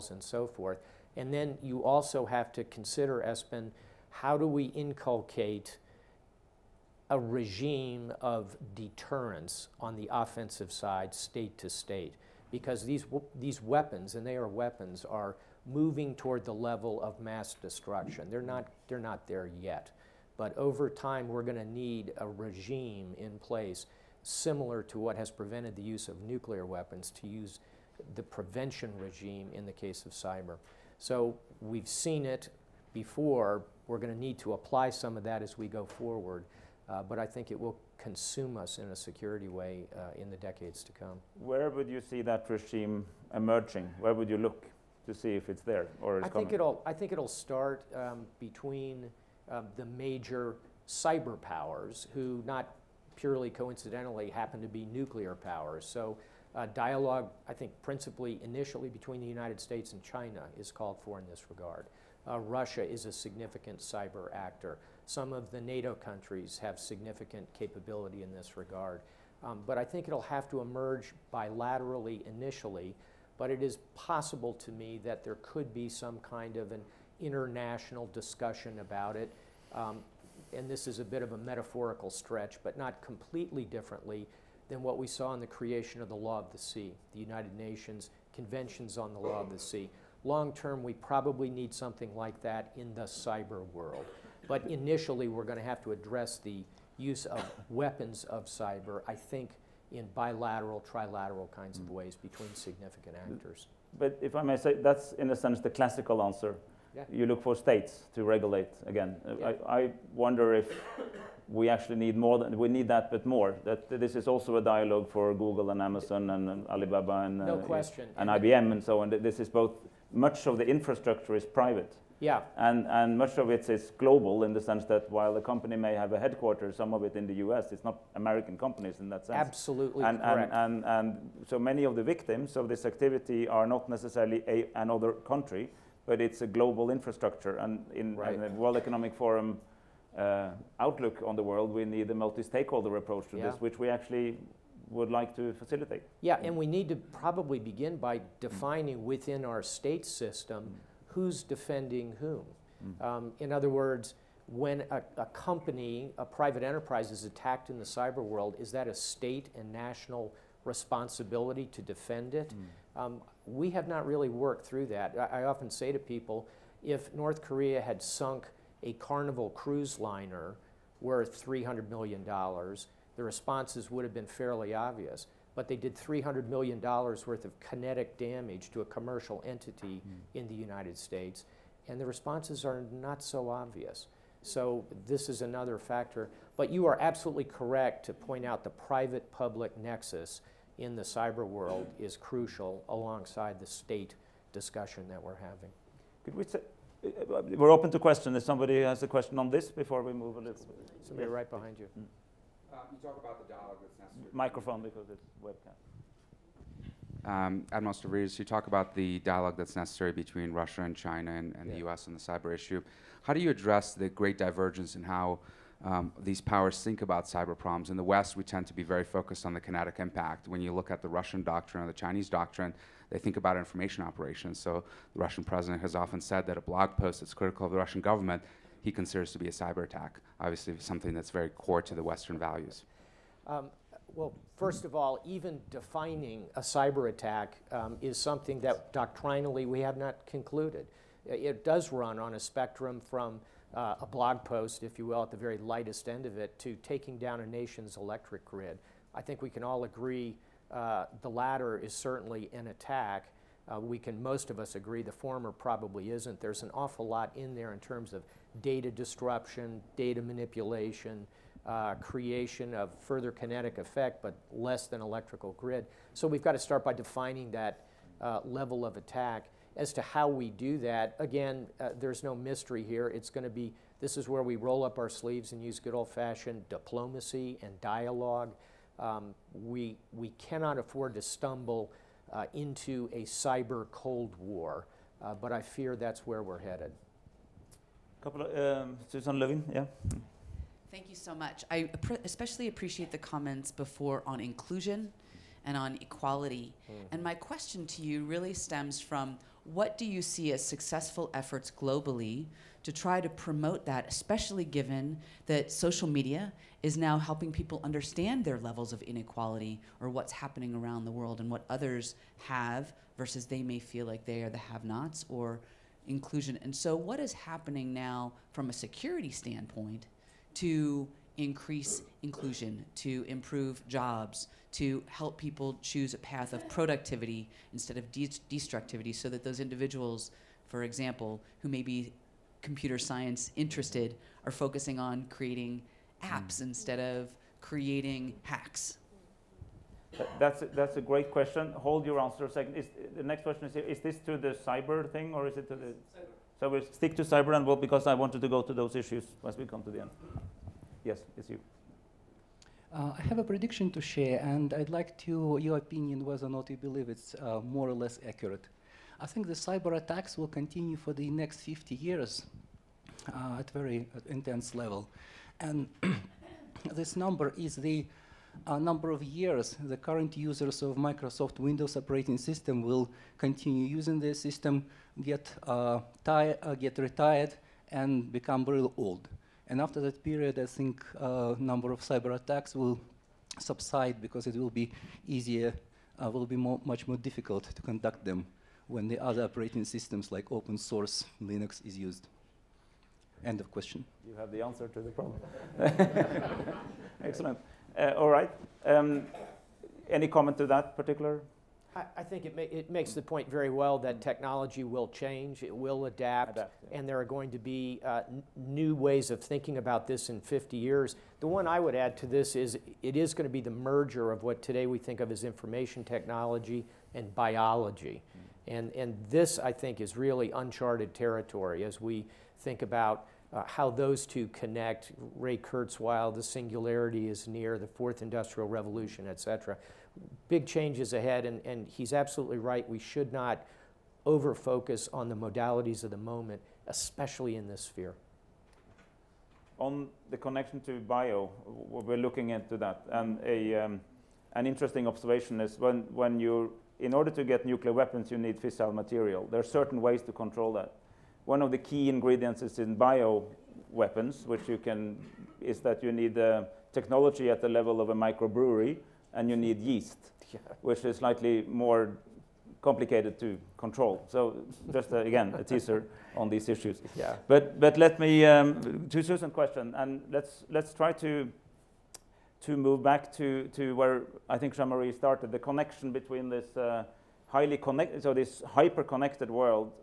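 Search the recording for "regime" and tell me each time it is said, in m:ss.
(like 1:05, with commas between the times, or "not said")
0:07, 0:22, 0:28, 0:42.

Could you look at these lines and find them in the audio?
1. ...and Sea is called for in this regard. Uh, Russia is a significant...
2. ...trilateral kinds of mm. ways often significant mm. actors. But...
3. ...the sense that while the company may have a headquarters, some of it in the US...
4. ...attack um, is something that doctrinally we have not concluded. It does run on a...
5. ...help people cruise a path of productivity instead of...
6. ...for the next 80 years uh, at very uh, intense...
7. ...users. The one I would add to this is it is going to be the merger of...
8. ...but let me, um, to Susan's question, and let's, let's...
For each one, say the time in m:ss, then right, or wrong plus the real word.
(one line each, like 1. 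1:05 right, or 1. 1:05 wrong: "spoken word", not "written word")
1. 0:59 wrong: "China", not "Sea"
2. 1:40 wrong: "between", not "often"
3. 2:04 right
4. 3:57 right
5. 5:25 wrong: "choose", not "cruise"
6. 6:00 wrong: "50", not "80"
7. 6:50 wrong: "years", not "users"
8. 7:47 right.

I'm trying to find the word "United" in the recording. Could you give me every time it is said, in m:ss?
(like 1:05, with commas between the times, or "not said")
0:59, 1:27, 3:00.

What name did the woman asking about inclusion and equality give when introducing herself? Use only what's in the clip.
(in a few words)
Susan Levin.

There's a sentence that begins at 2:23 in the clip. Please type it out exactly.
this, which we actually would like to facilitate.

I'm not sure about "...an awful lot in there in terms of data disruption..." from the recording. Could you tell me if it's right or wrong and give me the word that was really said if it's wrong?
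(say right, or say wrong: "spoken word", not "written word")
right.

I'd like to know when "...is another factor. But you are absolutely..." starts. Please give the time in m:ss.
3:05.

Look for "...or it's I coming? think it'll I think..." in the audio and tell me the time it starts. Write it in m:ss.
0:45.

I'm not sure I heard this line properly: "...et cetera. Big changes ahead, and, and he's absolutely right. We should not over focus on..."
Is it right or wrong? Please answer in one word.
right.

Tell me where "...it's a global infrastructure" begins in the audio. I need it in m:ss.
2:16.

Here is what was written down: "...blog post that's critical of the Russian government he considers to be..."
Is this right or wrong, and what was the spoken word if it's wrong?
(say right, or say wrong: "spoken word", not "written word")
right.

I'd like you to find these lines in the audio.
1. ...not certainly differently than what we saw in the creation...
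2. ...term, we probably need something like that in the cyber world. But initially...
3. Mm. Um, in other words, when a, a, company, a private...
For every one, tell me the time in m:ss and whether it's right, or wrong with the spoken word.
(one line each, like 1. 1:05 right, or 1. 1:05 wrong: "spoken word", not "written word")
1. 1:22 wrong: "completely", not "certainly"
2. 1:30 right
3. 2:32 right.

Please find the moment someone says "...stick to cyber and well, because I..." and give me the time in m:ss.
5:46.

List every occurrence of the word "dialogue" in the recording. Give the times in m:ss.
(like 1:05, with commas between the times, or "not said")
0:56, 1:54, 3:23, 3:29, 4:37.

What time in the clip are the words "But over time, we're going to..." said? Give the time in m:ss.
0:20.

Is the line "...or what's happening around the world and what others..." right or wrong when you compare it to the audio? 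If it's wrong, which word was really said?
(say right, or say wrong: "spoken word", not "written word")
right.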